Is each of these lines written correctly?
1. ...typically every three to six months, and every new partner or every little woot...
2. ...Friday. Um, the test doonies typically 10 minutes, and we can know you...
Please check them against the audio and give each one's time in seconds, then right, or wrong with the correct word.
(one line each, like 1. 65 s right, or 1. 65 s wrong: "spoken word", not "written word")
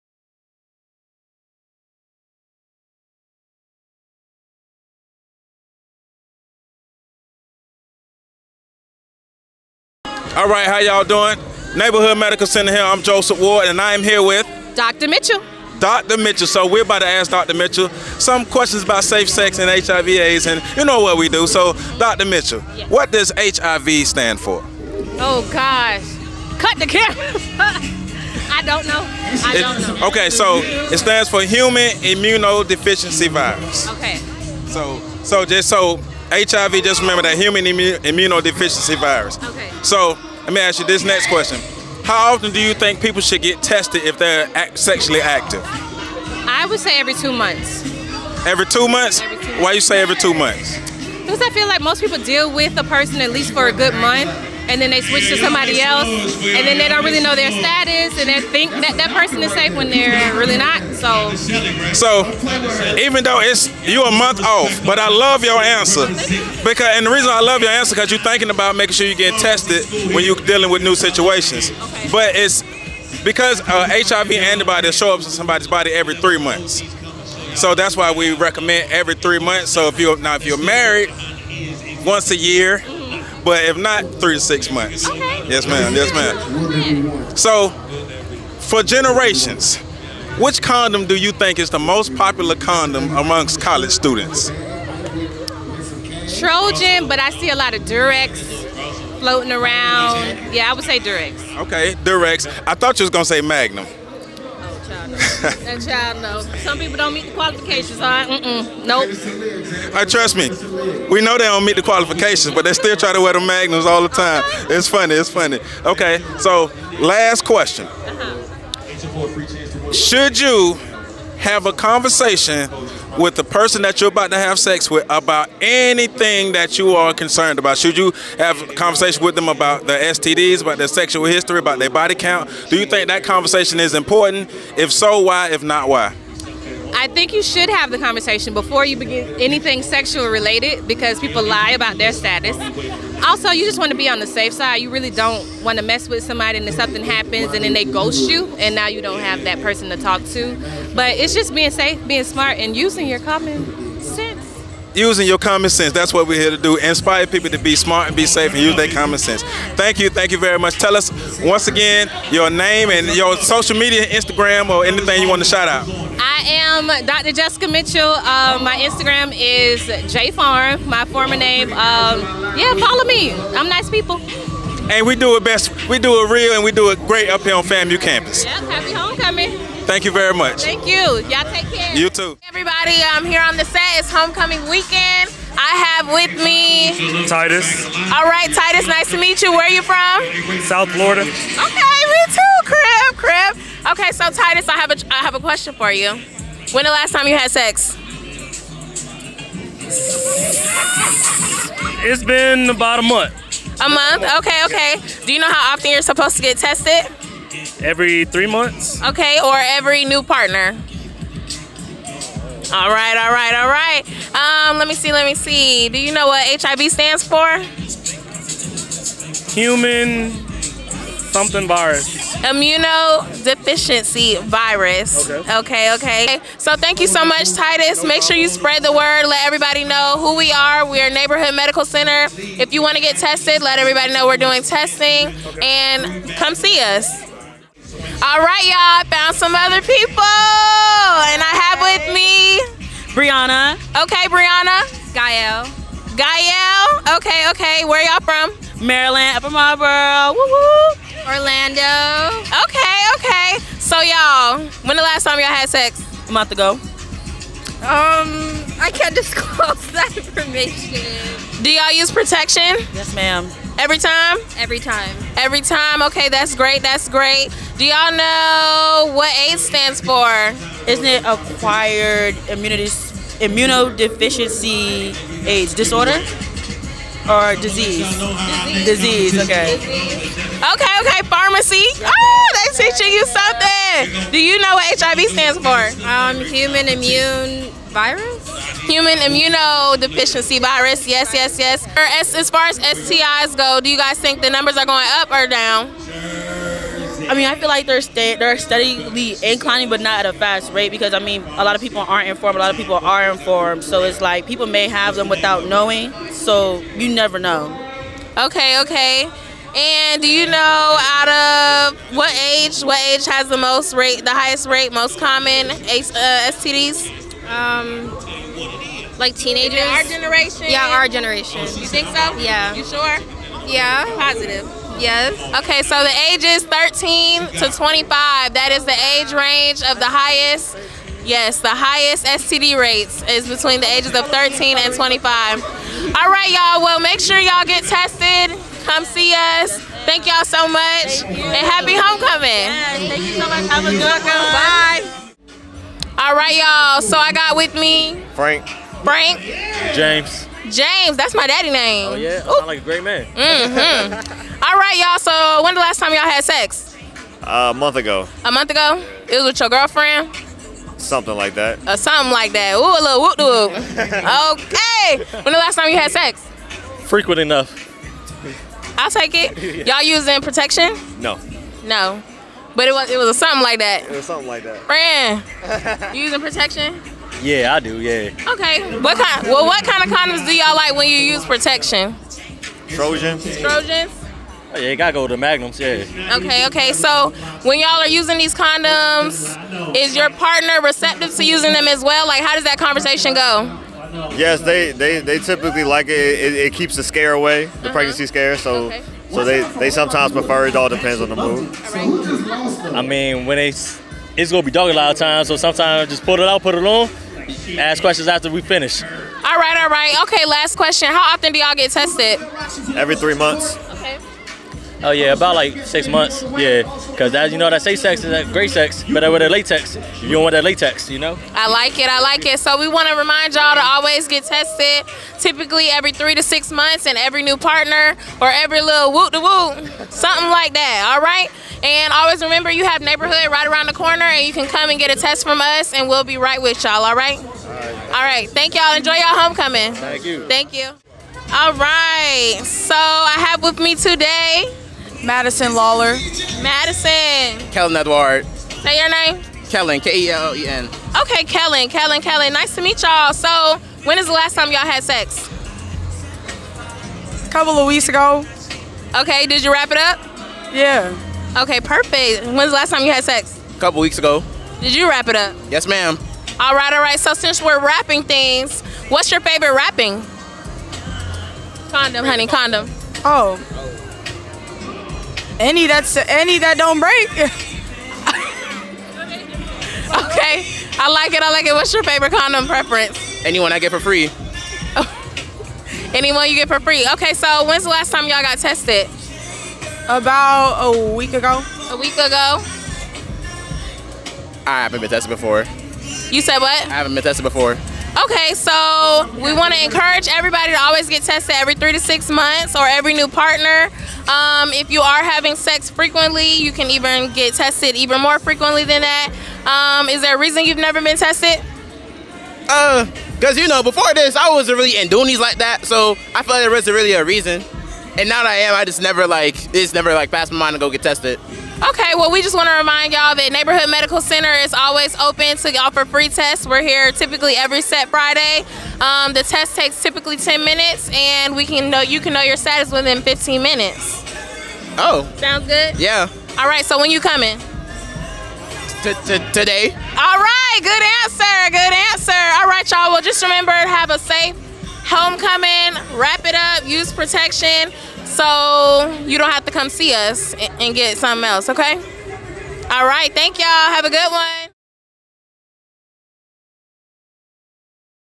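1. 425 s right
2. 528 s wrong: "takes", not "doonies".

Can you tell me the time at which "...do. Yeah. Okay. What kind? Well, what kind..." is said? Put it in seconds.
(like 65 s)
377 s.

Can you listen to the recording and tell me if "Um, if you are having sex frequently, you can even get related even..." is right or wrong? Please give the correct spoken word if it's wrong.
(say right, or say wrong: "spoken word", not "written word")
wrong: "tested", not "related".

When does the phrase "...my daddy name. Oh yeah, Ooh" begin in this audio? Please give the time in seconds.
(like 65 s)
351 s.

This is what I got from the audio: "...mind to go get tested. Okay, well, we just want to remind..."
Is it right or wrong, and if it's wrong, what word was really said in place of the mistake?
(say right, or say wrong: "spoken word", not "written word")
right.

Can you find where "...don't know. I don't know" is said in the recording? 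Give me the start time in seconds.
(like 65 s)
28 s.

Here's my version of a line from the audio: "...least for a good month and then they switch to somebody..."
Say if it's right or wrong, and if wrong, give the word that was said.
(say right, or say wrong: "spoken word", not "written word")
right.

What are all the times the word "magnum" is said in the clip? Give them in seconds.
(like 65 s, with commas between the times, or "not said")
103 s, 113 s, 385 s.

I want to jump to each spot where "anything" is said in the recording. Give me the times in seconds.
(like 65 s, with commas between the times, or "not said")
125 s, 139 s, 164 s.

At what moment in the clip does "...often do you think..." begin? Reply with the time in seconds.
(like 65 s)
42 s.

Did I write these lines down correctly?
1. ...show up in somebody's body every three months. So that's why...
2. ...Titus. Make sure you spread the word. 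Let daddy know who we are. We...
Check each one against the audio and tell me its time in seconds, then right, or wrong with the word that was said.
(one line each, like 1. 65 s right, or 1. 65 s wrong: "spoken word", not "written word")
1. 74 s right
2. 227 s wrong: "everybody", not "daddy".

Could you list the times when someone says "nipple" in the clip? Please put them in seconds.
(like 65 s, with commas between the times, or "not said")
not said.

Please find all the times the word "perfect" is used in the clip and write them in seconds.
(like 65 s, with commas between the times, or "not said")
461 s.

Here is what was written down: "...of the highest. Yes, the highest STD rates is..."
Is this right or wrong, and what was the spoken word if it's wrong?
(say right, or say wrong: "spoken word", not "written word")
right.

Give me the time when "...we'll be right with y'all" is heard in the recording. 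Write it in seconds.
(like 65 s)
436 s.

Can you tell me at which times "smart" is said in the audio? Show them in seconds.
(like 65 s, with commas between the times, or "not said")
152 s, 157 s.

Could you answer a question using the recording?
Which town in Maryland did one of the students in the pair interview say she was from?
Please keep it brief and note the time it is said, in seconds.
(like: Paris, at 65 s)
Upper Marlboro, at 249 s.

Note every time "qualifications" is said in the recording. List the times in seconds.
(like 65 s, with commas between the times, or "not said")
107 s, 111 s.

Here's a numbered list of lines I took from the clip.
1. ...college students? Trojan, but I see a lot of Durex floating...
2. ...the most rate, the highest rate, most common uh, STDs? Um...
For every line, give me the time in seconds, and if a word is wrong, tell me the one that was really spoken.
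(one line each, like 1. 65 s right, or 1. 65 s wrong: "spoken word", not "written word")
1. 93 s right
2. 313 s right.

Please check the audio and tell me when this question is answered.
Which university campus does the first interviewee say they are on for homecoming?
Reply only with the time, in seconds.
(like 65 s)
177 s.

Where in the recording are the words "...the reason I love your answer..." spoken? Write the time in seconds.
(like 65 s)
67 s.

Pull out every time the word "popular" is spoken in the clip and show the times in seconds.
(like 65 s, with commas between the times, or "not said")
92 s.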